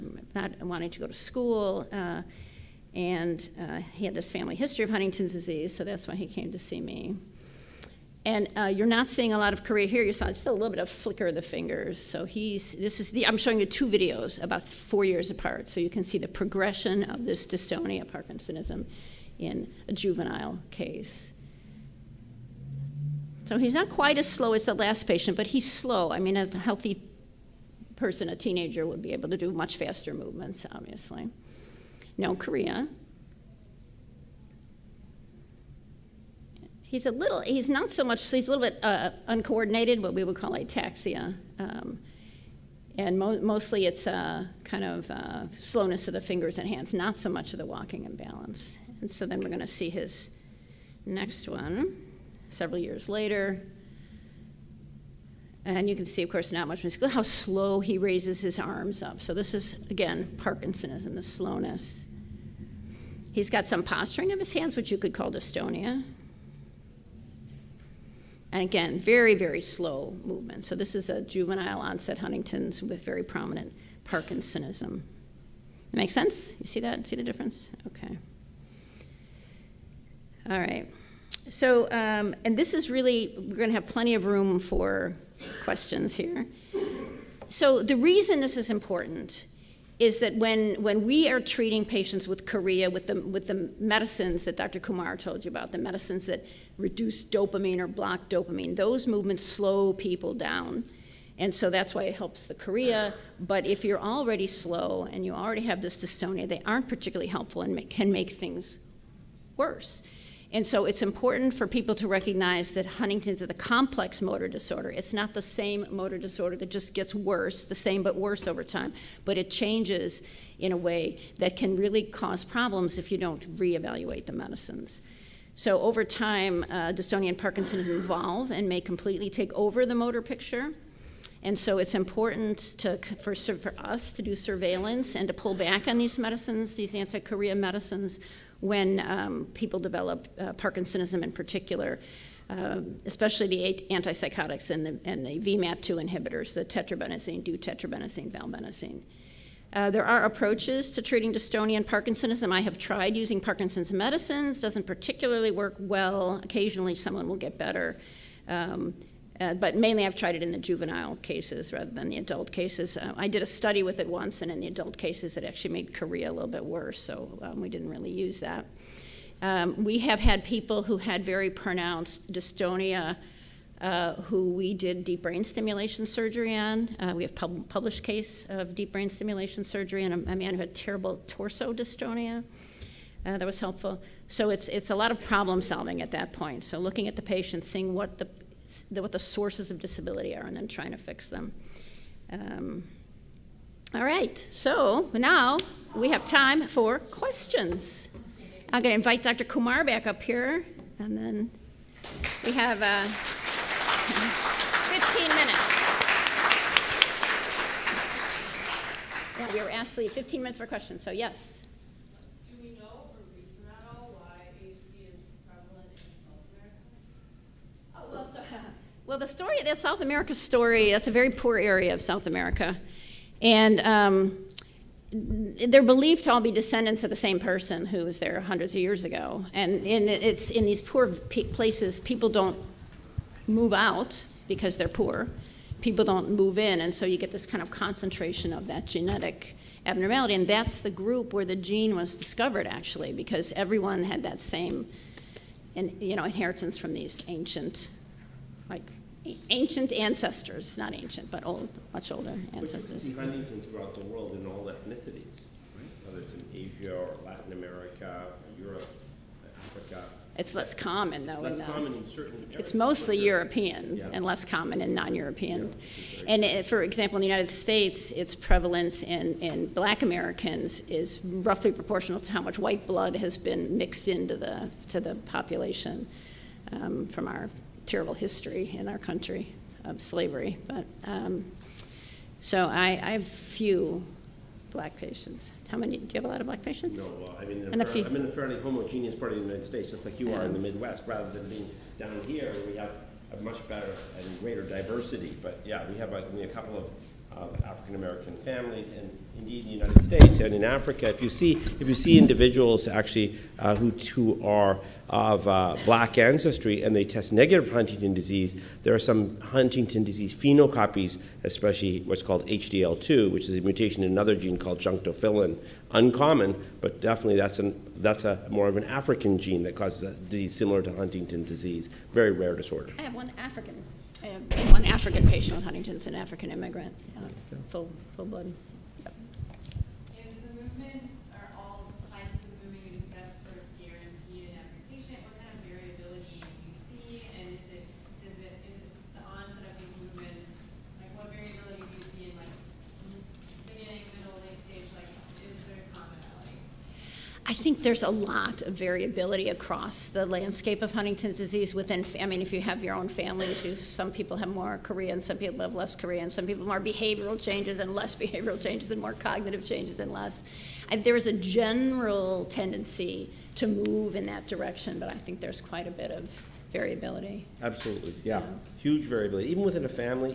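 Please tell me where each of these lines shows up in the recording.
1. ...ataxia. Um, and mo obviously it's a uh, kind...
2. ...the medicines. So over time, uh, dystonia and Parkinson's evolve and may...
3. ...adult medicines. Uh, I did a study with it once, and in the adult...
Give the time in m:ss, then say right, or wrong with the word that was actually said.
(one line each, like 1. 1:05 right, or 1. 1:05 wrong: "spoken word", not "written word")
1. 0:40 wrong: "mostly", not "obviously"
2. 2:04 right
3. 2:42 wrong: "cases", not "medicines".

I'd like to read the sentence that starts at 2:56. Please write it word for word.
Uh, we have pub published case of deep brain stimulation surgery in a, a man who had terrible torso dystonia.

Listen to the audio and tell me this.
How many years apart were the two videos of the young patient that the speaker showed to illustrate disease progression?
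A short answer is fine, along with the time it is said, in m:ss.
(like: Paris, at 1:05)
4 years, at 0:14.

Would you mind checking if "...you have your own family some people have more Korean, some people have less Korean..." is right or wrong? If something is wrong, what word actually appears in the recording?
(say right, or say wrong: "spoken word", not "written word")
right.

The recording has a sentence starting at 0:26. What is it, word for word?
I mean, a healthy person, a teenager, would be able to do much faster movements, obviously no chorea.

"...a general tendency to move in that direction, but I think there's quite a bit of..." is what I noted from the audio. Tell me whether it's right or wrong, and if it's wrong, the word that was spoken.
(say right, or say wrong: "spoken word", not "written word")
right.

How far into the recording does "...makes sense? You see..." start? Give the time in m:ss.
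1:15.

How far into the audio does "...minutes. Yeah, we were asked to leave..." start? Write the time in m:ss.
3:29.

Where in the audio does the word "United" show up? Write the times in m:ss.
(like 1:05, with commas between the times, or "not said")
4:27, 4:49, 4:59.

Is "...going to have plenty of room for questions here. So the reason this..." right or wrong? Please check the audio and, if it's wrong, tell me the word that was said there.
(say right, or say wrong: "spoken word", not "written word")
right.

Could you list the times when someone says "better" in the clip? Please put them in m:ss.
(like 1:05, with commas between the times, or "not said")
2:37, 4:53.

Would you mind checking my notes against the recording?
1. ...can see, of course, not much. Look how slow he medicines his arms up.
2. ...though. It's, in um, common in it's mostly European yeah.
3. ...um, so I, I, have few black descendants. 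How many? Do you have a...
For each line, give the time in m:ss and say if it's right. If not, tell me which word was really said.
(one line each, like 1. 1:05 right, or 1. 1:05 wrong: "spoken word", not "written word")
1. 0:55 wrong: "raises", not "medicines"
2. 4:21 right
3. 4:41 wrong: "patients", not "descendants".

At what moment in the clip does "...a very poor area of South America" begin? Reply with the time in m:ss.
3:41.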